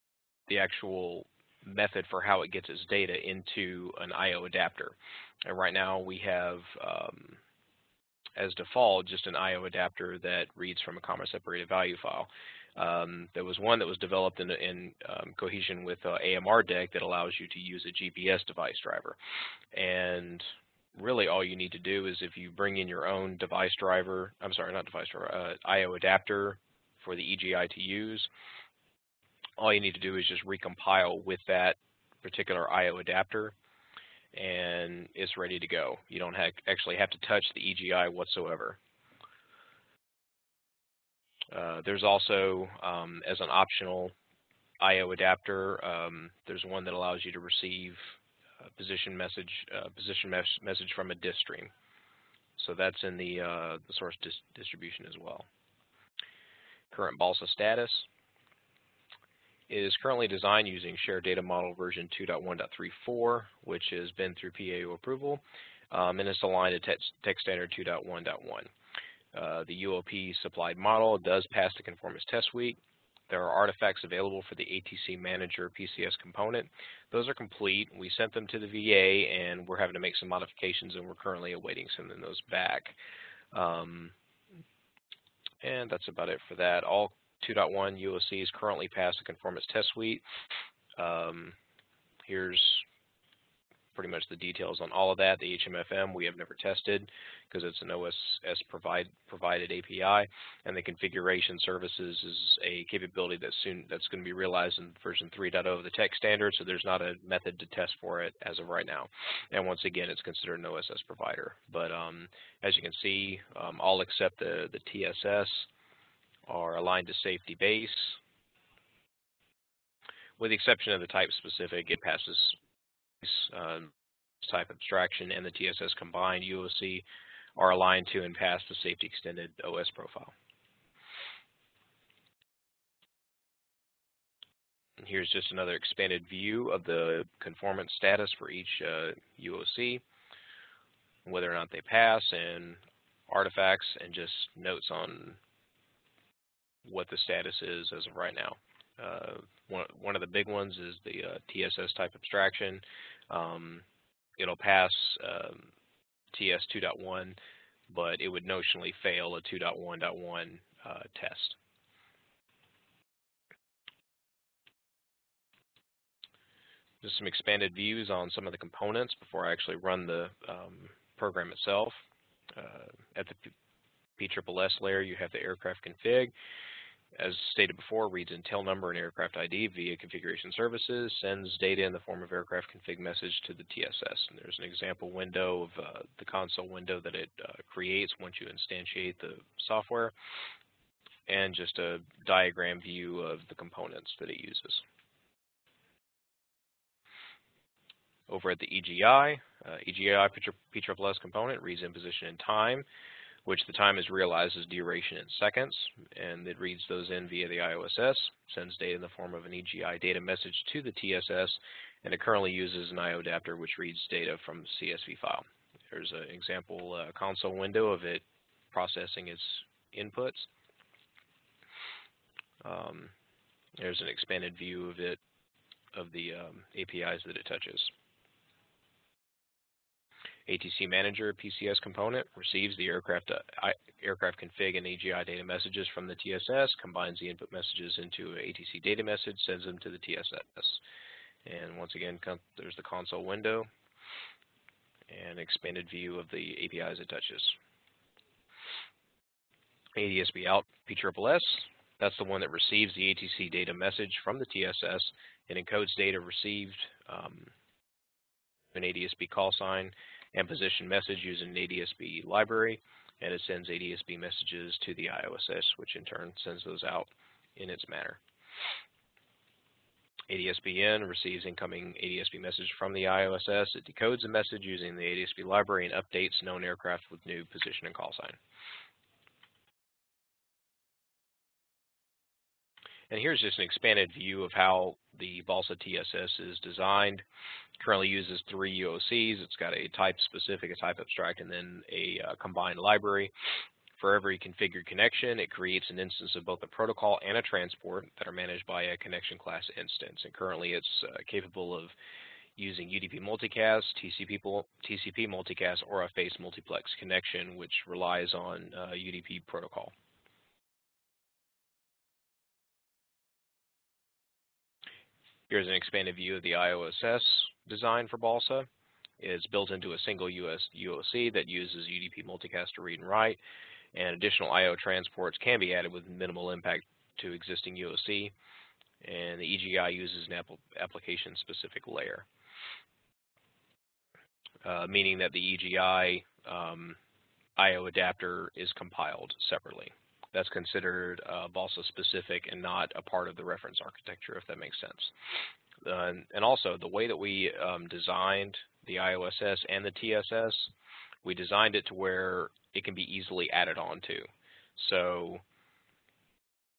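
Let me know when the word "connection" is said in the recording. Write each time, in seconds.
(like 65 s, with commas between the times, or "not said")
294 s, 298 s, 306 s.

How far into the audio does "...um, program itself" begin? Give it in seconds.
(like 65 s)
170 s.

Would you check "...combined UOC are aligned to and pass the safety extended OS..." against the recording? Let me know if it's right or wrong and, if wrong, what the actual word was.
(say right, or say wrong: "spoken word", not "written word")
right.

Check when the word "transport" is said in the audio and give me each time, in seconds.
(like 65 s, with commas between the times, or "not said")
297 s, 324 s.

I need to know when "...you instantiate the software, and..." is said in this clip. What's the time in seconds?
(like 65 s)
188 s.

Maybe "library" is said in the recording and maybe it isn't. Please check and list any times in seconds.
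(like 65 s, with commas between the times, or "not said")
262 s, 275 s, 292 s.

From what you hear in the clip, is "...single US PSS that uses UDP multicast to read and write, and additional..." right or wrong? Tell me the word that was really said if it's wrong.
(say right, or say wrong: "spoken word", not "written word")
wrong: "UOC", not "PSS".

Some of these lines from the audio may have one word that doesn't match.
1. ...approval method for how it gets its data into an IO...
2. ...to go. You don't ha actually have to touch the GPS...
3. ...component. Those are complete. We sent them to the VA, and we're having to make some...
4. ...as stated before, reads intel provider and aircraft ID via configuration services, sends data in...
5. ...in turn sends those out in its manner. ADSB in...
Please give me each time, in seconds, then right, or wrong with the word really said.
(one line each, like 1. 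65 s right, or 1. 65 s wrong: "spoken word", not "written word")
1. 0 s wrong: "actual", not "approval"
2. 35 s wrong: "EGI", not "GPS"
3. 76 s right
4. 177 s wrong: "number", not "provider"
5. 265 s right.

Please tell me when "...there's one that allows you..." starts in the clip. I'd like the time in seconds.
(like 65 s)
46 s.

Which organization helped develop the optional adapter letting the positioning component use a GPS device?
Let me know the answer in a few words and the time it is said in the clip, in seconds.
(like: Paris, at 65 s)
AMRDEC, at 16 s.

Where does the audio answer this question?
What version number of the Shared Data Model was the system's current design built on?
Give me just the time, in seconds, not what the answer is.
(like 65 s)
62 s.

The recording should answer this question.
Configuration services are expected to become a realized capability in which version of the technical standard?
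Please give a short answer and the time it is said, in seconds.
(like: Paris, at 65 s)
3.0, at 105 s.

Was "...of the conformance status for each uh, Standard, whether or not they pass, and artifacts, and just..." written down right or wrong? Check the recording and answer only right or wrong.
wrong.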